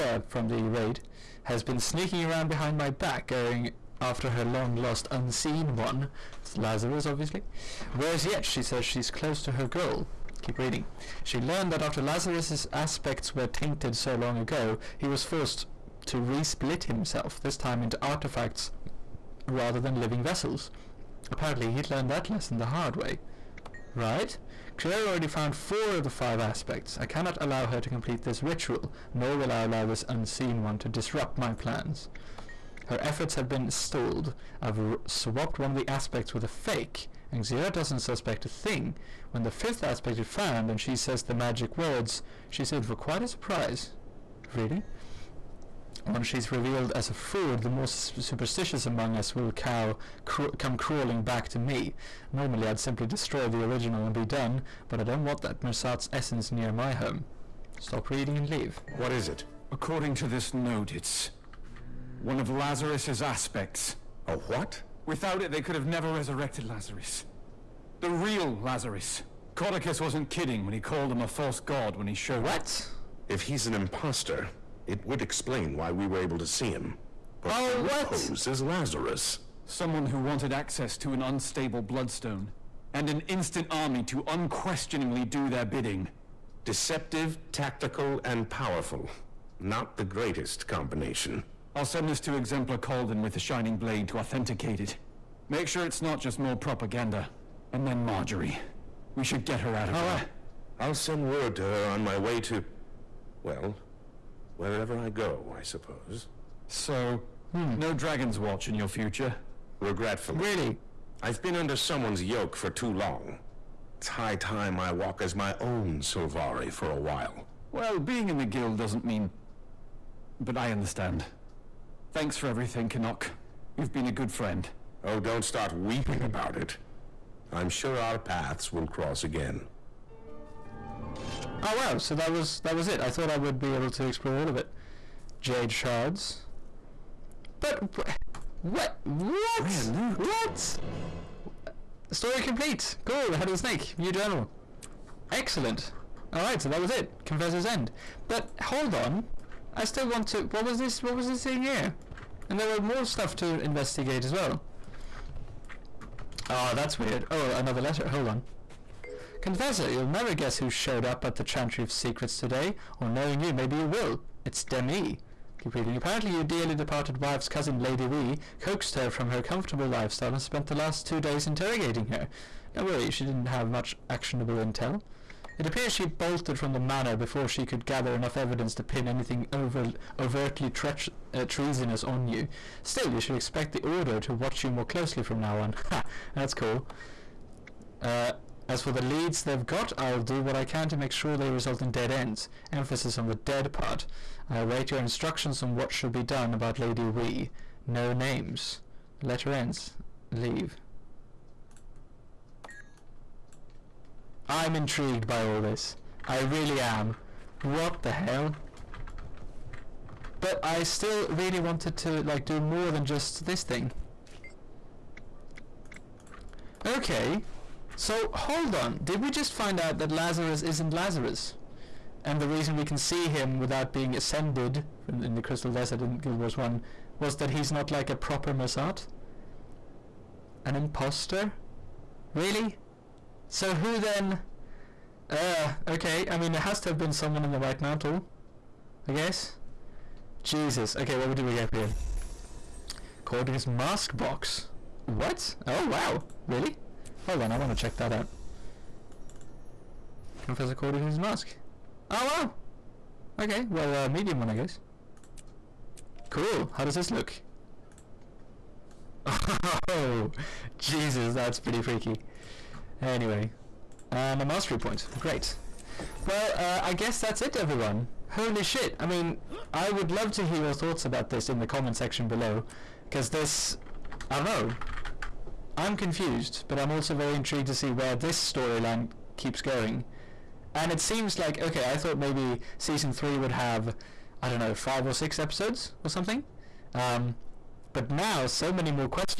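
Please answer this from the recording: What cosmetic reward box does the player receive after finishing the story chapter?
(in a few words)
Caudecus mask box.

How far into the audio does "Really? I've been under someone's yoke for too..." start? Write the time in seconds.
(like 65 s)
110 s.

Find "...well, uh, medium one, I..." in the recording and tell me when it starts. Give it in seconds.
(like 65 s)
253 s.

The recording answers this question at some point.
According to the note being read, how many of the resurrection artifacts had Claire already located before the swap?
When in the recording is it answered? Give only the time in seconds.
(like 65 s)
25 s.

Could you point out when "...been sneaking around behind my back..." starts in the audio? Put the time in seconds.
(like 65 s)
1 s.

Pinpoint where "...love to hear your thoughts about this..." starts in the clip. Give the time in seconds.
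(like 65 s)
270 s.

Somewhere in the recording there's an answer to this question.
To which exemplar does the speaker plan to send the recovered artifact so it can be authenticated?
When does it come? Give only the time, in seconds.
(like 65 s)
92 s.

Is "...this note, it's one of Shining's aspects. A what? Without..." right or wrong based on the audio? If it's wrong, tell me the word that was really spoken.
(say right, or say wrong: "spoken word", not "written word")
wrong: "Lazarus", not "Shining".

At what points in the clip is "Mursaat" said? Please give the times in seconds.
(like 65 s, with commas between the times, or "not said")
55 s, 228 s.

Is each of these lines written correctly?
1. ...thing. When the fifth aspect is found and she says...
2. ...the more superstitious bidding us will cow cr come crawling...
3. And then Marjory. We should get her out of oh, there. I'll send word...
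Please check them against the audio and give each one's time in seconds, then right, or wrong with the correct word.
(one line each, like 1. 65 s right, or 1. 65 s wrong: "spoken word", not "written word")
1. 38 s right
2. 47 s wrong: "among", not "bidding"
3. 97 s right.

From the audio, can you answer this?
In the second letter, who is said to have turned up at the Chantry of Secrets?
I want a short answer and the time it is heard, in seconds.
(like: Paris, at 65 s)
Demmi, at 164 s.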